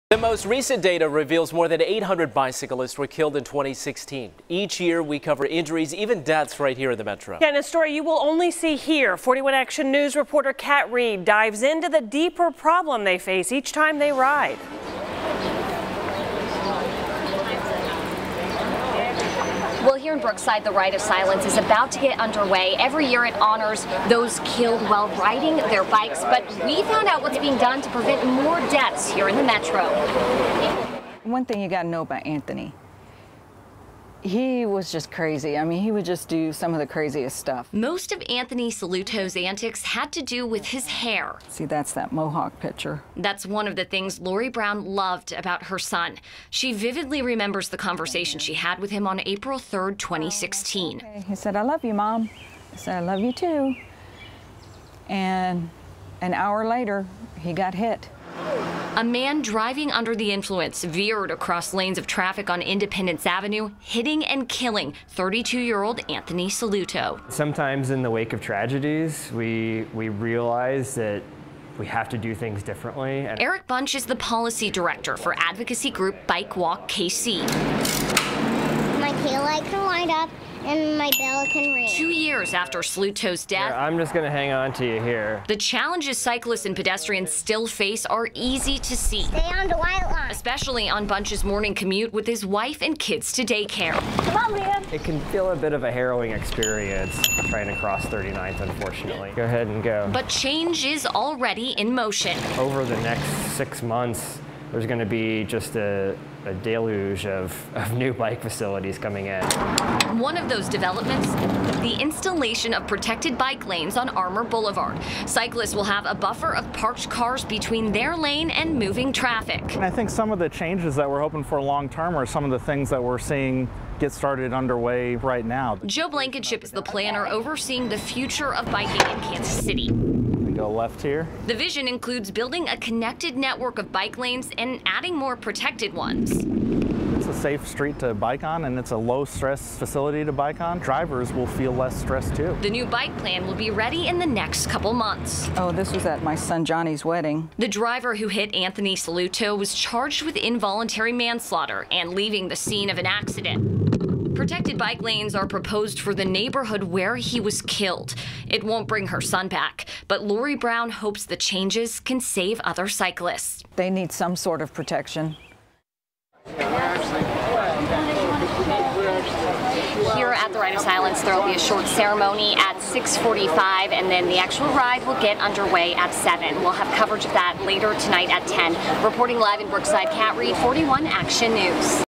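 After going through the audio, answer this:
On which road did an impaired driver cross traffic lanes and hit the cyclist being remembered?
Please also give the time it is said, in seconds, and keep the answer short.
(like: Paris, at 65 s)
Independence Avenue, at 62 s.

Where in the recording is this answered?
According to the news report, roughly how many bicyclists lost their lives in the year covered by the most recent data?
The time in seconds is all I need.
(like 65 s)
1 s.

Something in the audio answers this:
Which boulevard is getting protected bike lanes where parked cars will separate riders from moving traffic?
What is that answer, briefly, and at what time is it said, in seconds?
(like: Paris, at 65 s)
Armour Boulevard, at 114 s.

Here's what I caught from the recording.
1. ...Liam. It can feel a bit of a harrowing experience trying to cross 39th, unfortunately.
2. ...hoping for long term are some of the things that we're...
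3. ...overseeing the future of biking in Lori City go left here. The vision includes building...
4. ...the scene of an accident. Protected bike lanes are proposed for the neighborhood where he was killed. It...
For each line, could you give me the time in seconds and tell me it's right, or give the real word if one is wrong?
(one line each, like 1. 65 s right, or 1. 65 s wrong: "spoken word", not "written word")
1. 94 s right
2. 121 s right
3. 127 s wrong: "Kansas", not "Lori"
4. 152 s right.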